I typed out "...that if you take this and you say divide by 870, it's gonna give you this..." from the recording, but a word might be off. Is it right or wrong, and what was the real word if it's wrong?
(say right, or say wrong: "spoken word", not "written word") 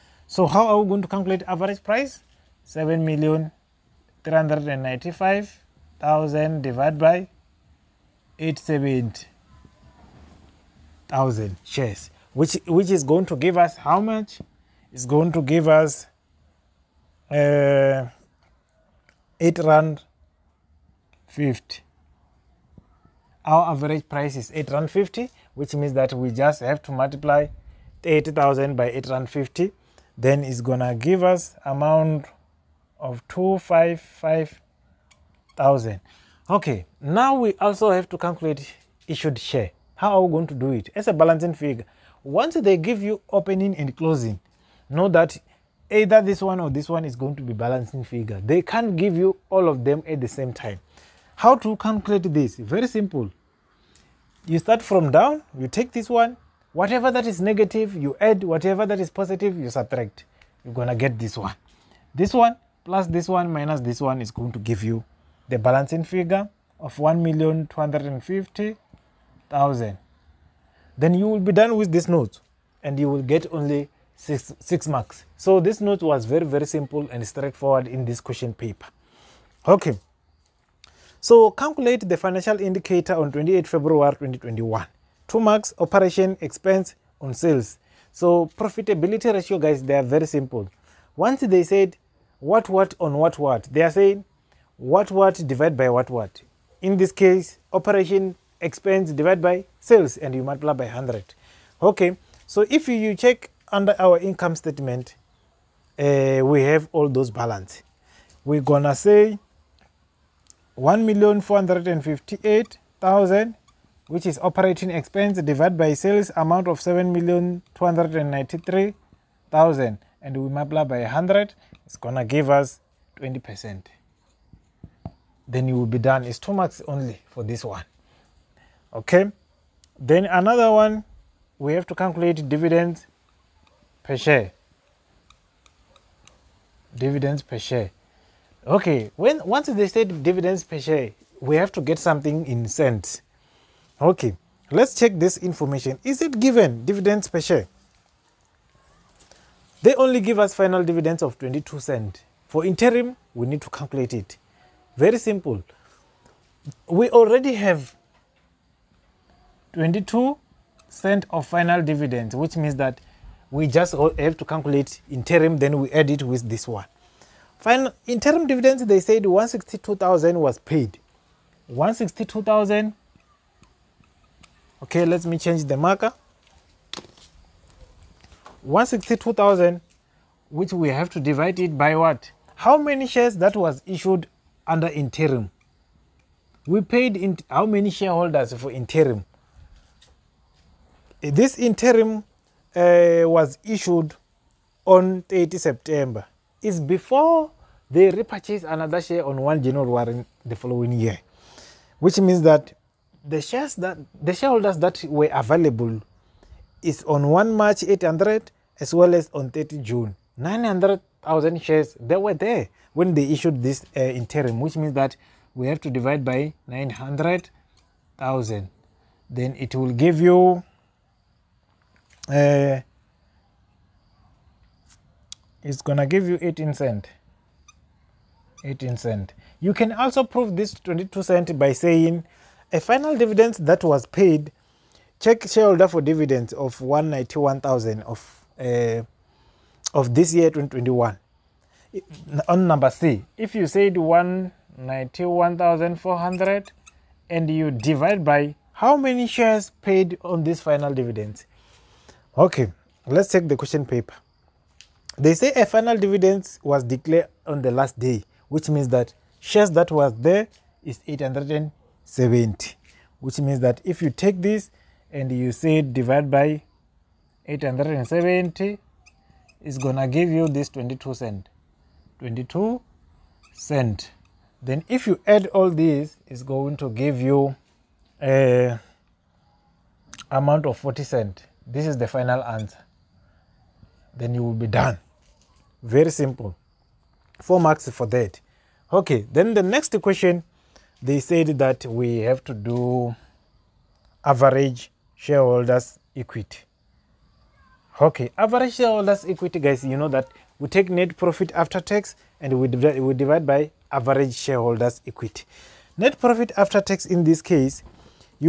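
right.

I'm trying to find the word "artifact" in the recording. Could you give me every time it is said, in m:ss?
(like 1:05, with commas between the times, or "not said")
not said.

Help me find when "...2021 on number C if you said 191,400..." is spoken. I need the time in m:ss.
4:00.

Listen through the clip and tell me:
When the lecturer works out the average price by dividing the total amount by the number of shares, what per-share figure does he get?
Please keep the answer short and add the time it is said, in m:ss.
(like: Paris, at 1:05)
R8.50, at 0:19.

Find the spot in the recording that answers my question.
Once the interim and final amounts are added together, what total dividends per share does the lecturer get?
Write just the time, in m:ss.
4:40.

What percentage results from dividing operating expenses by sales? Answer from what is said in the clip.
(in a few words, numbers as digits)
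20 percent.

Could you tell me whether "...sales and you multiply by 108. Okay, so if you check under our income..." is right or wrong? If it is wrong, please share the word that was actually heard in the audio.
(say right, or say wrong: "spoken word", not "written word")
wrong: "100", not "108".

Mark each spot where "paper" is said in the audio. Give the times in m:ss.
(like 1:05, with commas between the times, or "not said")
1:18, 4:13.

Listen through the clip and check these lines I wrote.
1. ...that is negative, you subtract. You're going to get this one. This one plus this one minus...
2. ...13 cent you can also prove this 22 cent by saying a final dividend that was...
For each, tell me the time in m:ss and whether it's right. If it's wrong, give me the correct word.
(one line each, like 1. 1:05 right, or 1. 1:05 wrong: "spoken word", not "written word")
1. 0:58 wrong: "positive", not "negative"
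2. 3:48 wrong: "18", not "13".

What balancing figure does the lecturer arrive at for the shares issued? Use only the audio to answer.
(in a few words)
1,250,000.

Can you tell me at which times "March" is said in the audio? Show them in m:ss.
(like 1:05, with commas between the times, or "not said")
3:27.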